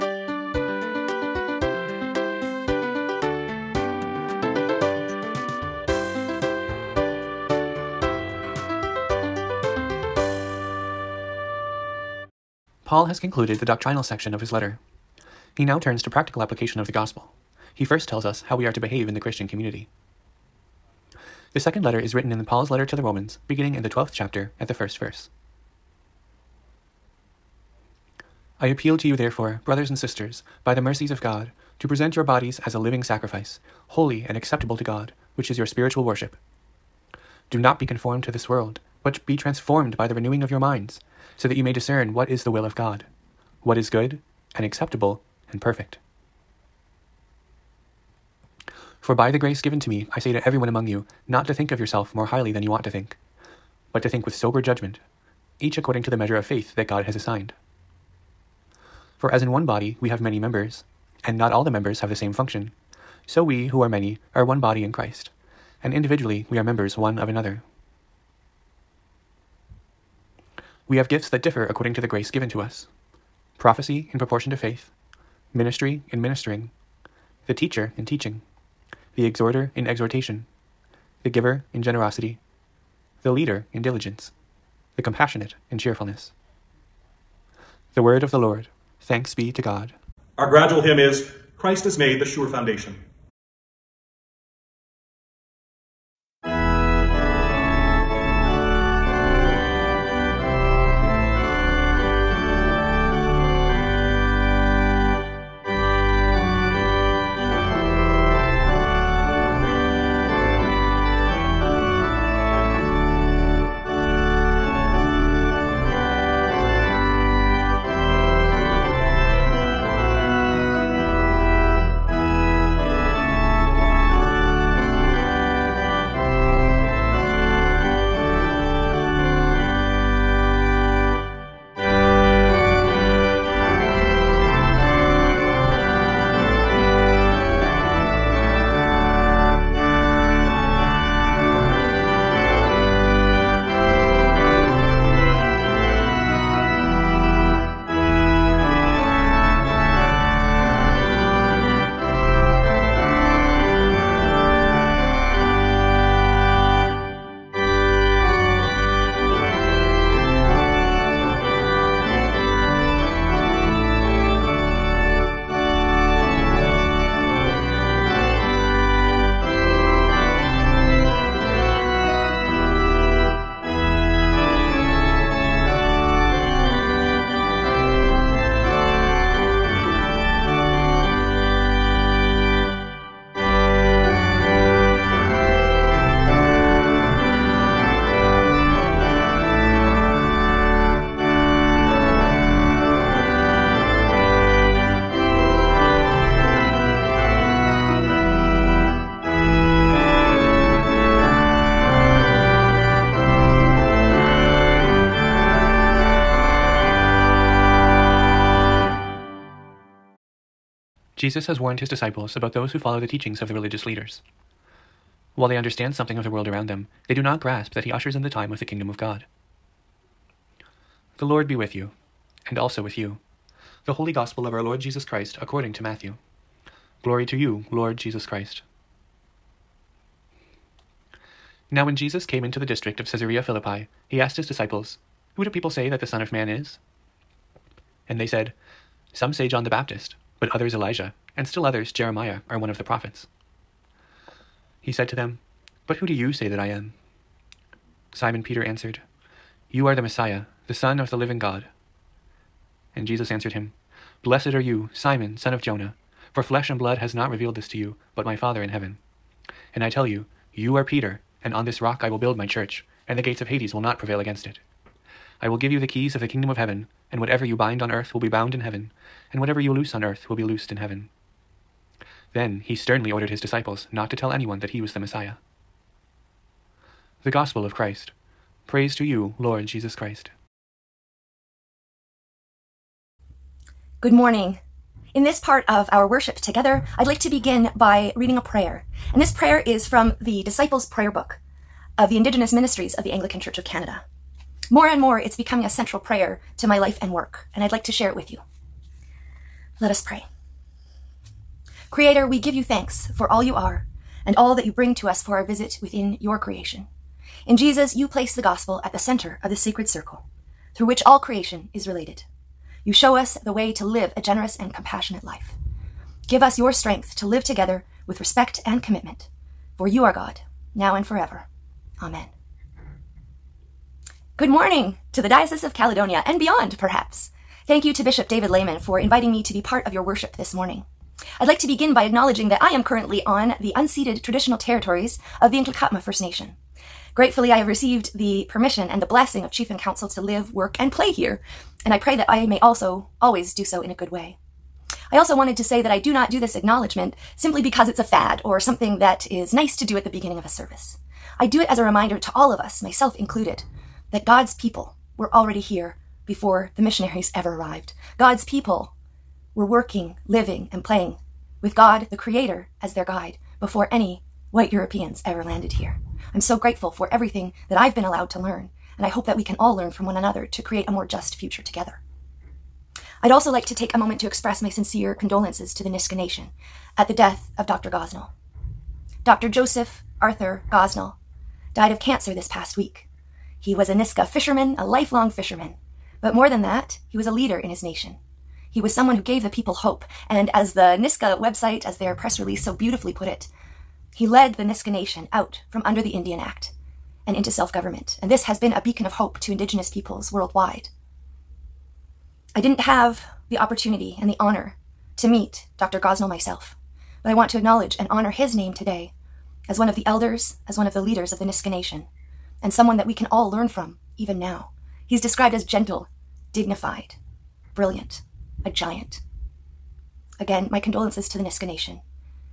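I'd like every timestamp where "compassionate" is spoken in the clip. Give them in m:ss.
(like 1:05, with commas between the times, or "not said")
1:25, 5:14.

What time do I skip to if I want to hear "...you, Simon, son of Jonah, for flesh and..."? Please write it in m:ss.
4:14.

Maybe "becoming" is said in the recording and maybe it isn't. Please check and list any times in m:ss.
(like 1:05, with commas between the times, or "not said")
4:55.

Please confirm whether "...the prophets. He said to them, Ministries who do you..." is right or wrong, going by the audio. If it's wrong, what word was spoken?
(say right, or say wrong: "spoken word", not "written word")
wrong: "But", not "Ministries".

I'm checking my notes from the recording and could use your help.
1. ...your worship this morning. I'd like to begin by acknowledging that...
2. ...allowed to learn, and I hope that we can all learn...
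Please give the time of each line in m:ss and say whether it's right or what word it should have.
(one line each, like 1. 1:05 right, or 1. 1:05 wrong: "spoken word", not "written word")
1. 5:29 right
2. 6:08 right.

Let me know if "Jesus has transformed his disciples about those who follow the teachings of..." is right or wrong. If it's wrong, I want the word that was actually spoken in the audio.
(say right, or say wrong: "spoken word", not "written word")
wrong: "warned", not "transformed".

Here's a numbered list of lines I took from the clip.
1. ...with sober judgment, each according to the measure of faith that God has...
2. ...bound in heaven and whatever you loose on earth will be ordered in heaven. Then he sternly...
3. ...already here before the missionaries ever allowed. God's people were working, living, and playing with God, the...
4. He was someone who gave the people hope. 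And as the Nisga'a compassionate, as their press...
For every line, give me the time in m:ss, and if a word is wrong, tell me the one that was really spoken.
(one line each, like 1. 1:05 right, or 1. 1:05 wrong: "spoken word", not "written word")
1. 0:54 right
2. 4:28 wrong: "loosed", not "ordered"
3. 5:55 wrong: "arrived", not "allowed"
4. 6:28 wrong: "website", not "compassionate".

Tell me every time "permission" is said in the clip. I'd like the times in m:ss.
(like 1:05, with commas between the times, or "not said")
5:38.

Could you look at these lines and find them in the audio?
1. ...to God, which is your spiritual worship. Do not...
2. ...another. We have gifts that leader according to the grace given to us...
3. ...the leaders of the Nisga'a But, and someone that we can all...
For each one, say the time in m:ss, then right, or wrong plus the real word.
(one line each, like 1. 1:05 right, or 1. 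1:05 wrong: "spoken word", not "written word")
1. 0:34 right
2. 1:07 wrong: "differ", not "leader"
3. 6:50 wrong: "Nation", not "But".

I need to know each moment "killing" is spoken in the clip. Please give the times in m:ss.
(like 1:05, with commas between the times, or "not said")
not said.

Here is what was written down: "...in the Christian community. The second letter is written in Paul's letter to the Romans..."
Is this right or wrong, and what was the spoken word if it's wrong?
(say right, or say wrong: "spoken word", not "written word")
right.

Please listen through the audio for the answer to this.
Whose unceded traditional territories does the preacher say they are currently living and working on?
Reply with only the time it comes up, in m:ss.
5:35.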